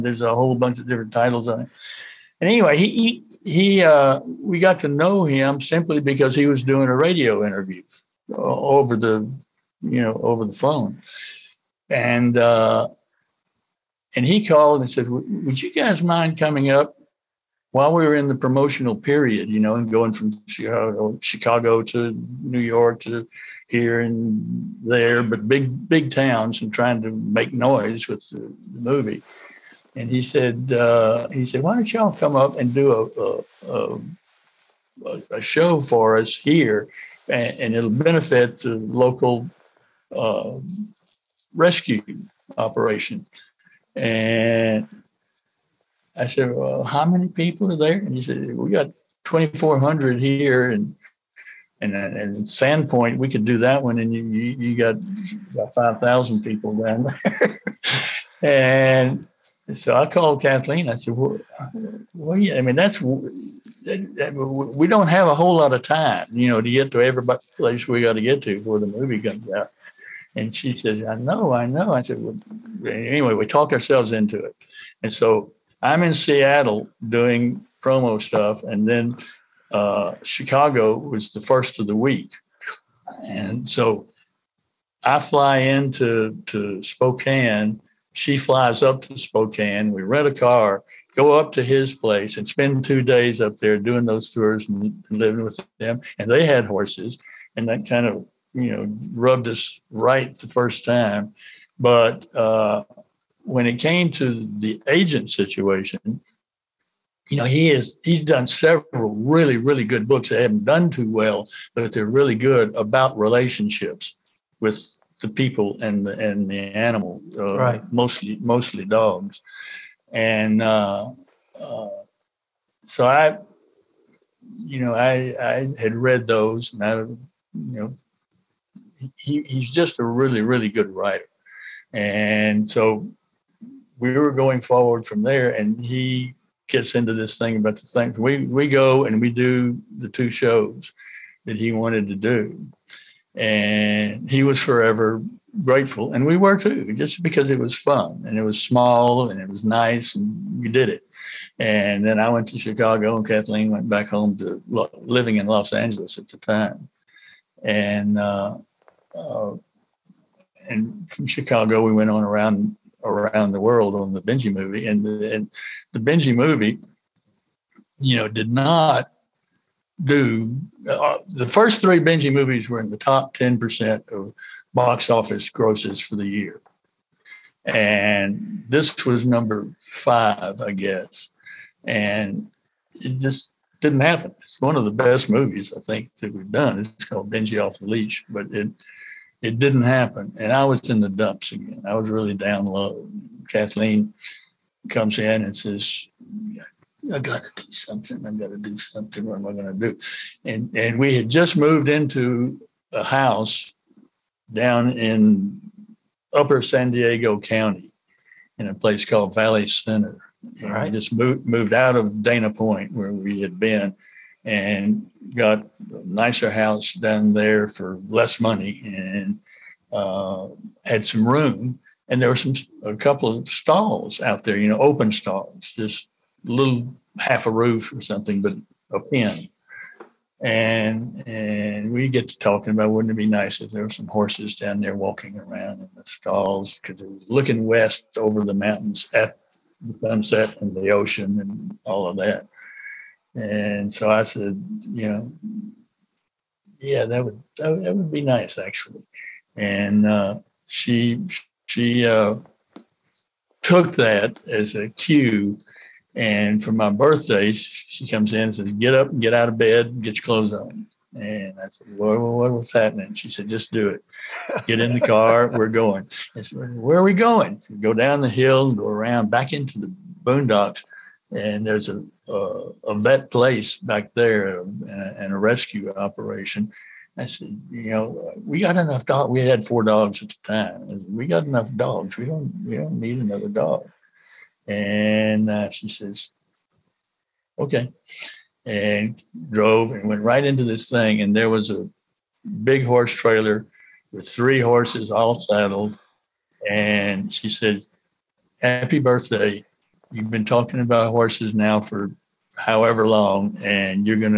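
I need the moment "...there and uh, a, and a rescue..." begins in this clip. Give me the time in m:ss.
4:34.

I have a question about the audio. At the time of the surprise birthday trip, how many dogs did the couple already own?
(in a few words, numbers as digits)
4.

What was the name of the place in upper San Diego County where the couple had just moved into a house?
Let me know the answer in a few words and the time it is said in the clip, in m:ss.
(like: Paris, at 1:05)
Valley Center, at 3:29.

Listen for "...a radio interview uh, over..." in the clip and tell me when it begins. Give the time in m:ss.
0:06.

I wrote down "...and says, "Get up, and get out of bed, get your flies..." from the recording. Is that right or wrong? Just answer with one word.
wrong.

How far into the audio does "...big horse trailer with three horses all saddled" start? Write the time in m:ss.
4:52.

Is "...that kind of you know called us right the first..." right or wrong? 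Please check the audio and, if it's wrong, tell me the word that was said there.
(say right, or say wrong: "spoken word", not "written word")
wrong: "rubbed", not "called".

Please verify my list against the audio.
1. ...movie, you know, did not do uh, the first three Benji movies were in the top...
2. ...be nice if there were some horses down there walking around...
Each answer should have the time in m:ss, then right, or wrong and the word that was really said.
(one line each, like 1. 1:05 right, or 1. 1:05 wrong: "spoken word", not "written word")
1. 2:46 right
2. 3:53 right.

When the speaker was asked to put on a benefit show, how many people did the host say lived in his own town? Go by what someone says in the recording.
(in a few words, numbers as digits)
2,400.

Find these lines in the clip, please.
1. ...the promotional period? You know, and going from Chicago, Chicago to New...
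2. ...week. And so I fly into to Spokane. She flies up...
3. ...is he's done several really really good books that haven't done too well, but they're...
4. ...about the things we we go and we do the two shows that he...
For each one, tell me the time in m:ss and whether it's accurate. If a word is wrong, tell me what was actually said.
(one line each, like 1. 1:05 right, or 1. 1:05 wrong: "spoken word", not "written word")
1. 0:18 right
2. 1:21 right
3. 1:47 right
4. 2:17 right.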